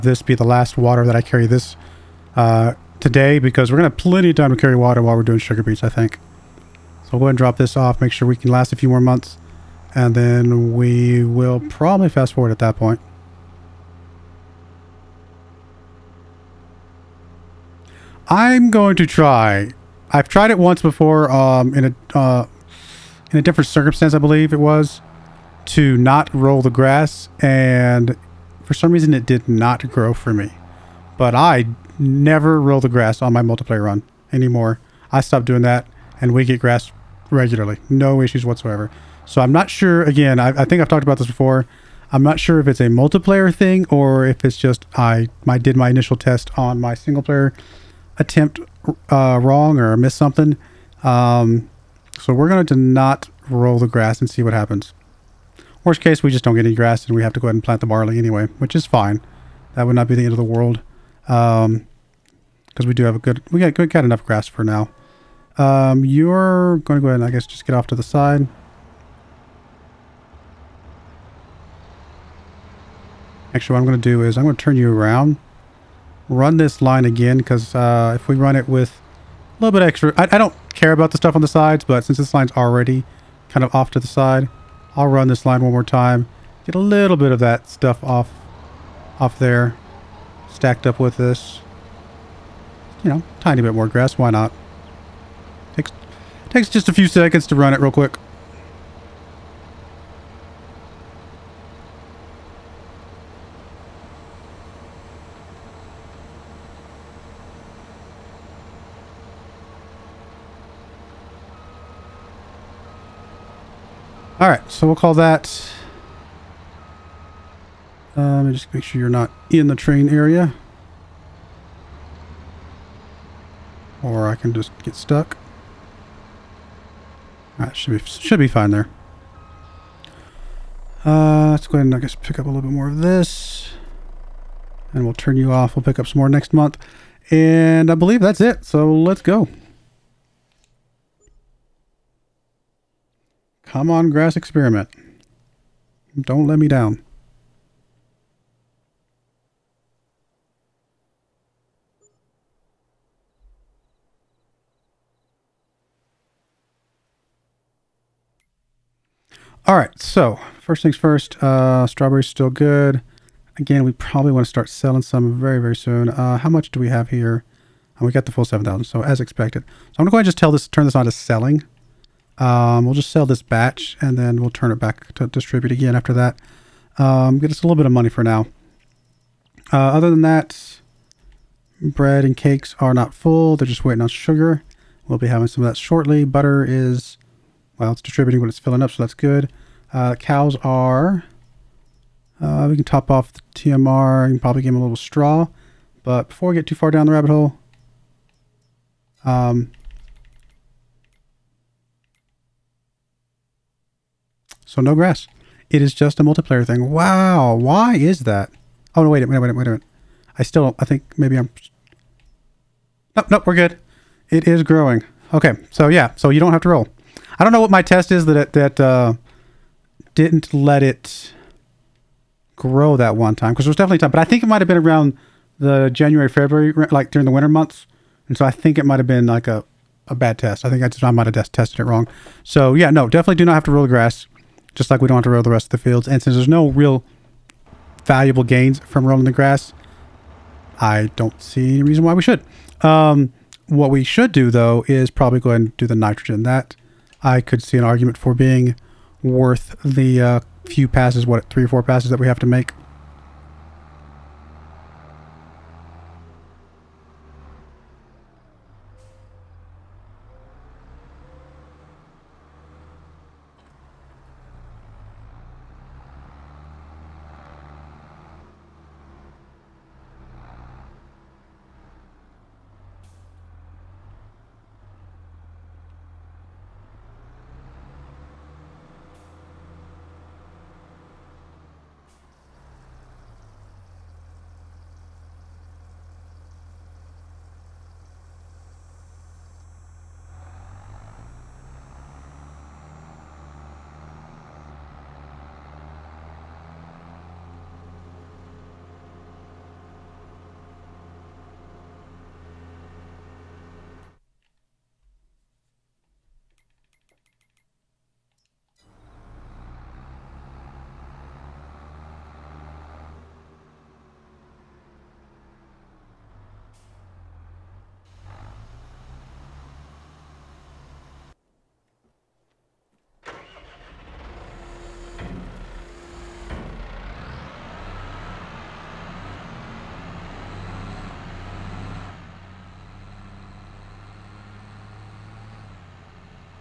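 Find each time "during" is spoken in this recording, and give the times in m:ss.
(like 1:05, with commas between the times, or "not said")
3:47.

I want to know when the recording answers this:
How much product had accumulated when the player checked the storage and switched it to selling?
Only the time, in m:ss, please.
2:48.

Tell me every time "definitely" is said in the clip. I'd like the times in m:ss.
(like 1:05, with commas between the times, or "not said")
3:43, 3:53.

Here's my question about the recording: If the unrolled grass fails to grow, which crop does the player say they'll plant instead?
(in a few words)
Barley.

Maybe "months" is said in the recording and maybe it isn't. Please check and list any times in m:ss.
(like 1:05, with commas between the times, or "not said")
0:08, 2:16, 3:47.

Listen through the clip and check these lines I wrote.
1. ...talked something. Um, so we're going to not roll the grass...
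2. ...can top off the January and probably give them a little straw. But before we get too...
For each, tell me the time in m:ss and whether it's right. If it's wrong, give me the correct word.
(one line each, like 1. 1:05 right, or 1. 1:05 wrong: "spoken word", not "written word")
1. 0:49 wrong: "missed", not "talked"
2. 3:12 wrong: "TMR", not "January".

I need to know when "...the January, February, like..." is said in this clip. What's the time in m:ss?
3:45.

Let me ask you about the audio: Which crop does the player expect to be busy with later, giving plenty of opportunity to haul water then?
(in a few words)
Sugar beets.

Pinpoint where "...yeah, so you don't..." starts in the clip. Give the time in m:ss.
3:35.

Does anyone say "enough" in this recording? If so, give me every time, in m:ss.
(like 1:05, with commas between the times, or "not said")
1:04.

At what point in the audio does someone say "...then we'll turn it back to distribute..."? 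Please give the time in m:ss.
2:54.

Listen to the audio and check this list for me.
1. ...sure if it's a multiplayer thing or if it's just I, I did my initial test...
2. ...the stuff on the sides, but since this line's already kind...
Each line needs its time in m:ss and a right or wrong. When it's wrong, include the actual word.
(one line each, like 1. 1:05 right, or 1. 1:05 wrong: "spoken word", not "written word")
1. 0:42 right
2. 1:21 right.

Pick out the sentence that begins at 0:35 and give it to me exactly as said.
I stopped doing that, and we get grass regularly.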